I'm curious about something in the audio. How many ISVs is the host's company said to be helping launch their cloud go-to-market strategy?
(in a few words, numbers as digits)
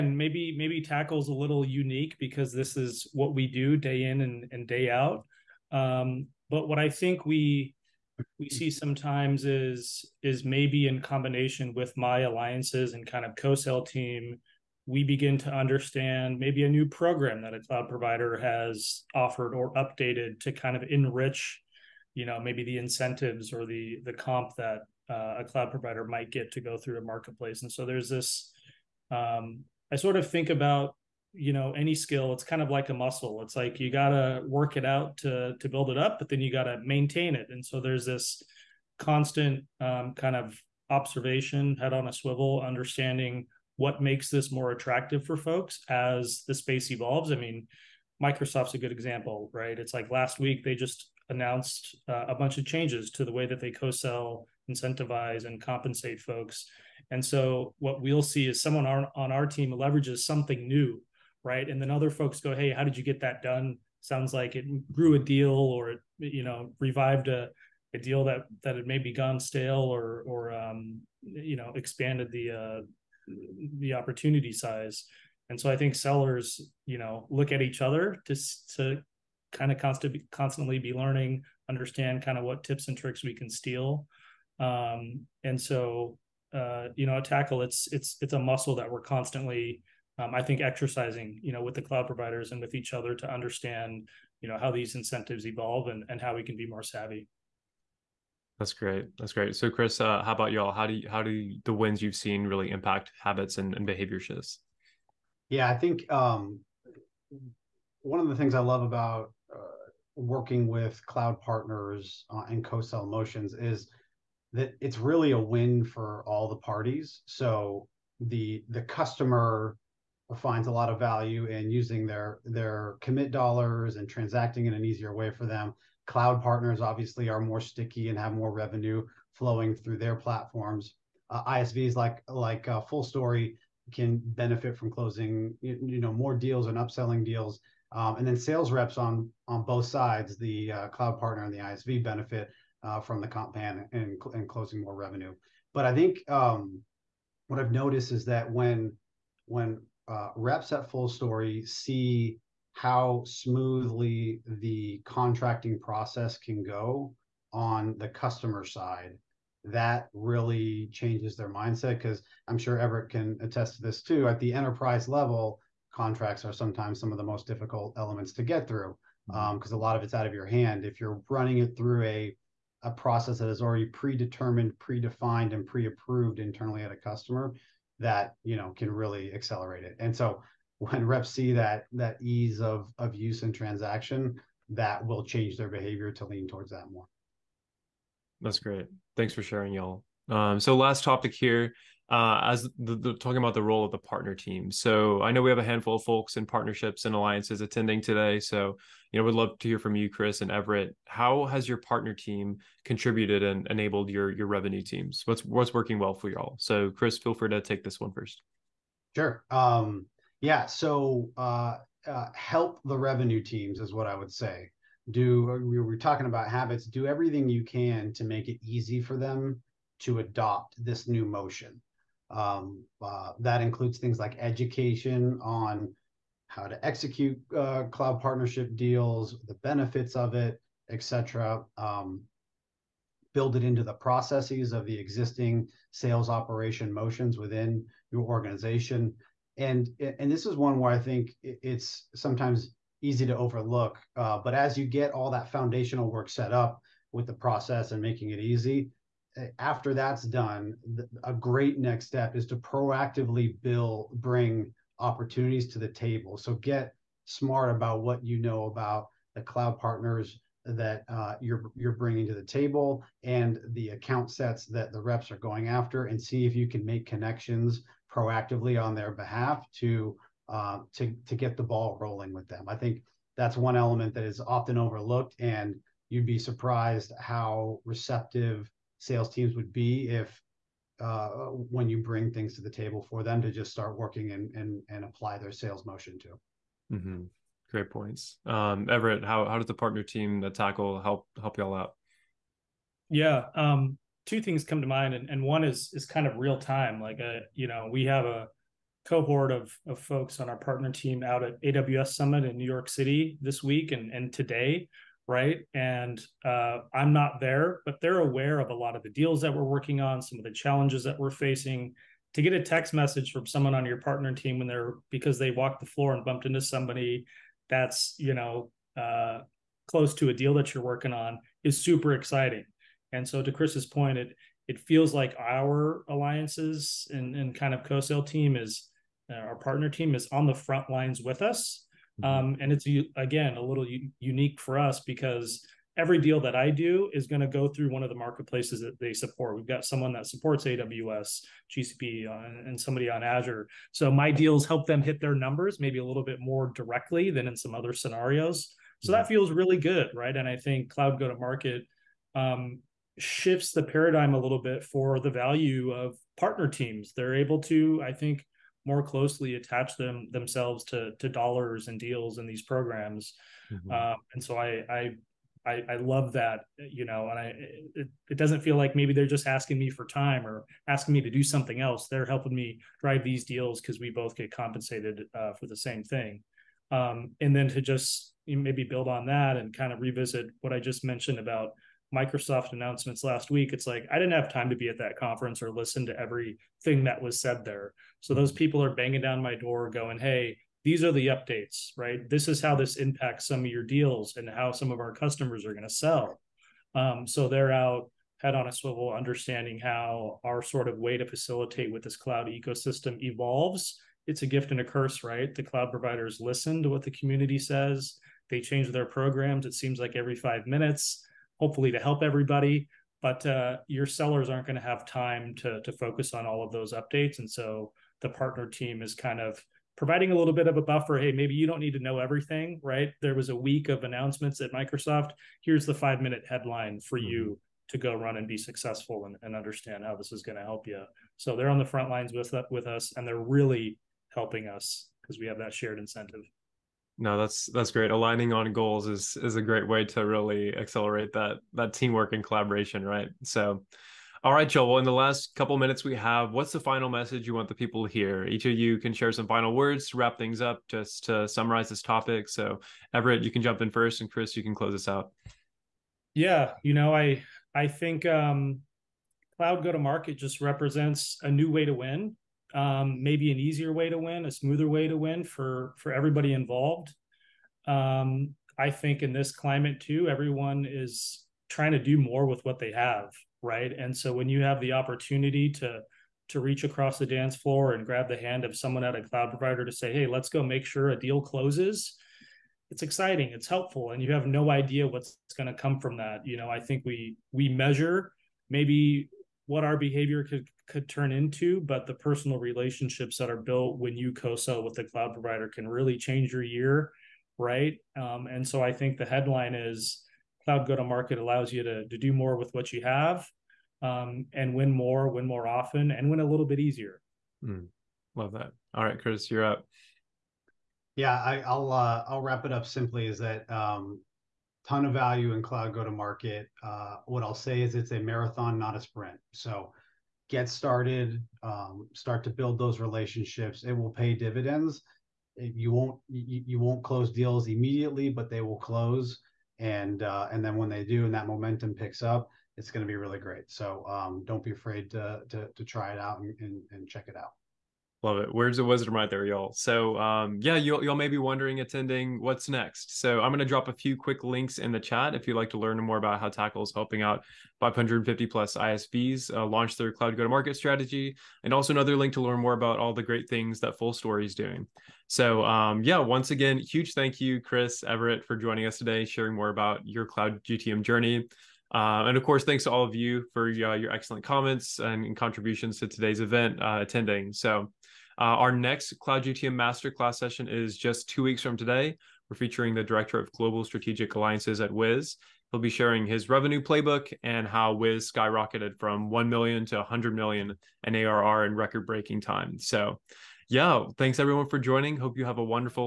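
550 plus.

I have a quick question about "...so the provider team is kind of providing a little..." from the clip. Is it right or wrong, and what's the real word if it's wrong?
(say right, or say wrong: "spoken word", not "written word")
wrong: "partner", not "provider".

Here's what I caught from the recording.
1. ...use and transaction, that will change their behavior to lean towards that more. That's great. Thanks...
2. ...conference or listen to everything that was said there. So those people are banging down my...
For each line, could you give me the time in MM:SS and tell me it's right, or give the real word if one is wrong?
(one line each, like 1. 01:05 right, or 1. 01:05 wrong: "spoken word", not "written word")
1. 03:03 right
2. 06:25 right.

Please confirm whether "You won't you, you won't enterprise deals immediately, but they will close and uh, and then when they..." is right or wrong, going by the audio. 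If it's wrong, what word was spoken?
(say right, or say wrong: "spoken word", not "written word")
wrong: "close", not "enterprise".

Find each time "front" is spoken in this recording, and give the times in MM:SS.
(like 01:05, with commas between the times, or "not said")
05:30, 07:11.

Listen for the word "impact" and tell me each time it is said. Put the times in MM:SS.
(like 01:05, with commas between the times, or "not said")
01:42, 06:32.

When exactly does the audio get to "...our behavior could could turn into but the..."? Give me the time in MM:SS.
08:09.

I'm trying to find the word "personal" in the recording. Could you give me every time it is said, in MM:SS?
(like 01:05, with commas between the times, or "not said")
08:12.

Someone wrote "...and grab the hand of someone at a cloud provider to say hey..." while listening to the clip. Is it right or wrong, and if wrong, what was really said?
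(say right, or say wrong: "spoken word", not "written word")
right.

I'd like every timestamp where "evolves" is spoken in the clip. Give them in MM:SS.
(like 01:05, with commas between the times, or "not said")
00:46, 01:35, 06:43.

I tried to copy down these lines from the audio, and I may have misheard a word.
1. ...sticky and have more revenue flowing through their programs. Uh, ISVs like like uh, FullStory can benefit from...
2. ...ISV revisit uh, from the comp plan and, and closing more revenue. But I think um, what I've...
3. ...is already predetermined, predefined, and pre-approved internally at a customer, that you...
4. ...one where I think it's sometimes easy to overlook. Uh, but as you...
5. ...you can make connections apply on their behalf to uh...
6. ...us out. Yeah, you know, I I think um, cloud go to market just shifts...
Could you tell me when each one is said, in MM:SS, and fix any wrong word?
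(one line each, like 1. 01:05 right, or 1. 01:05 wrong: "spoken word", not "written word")
1. 02:07 wrong: "platforms", not "programs"
2. 02:21 wrong: "benefit", not "revisit"
3. 02:53 right
4. 04:00 right
5. 04:26 wrong: "proactively", not "apply"
6. 07:34 wrong: "represents", not "shifts".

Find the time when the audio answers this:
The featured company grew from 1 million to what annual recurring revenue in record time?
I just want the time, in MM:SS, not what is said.
09:39.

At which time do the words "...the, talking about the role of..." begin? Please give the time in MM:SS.
03:12.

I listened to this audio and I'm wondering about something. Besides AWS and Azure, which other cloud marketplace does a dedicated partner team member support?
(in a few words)
GCP.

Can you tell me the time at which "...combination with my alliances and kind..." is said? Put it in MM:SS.
00:10.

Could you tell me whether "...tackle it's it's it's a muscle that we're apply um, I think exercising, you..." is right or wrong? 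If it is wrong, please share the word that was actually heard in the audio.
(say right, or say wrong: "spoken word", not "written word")
wrong: "constantly", not "apply".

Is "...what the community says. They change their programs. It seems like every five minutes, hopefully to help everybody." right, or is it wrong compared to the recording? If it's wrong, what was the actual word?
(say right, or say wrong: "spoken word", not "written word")
right.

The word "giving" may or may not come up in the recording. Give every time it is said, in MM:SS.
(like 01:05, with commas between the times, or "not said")
not said.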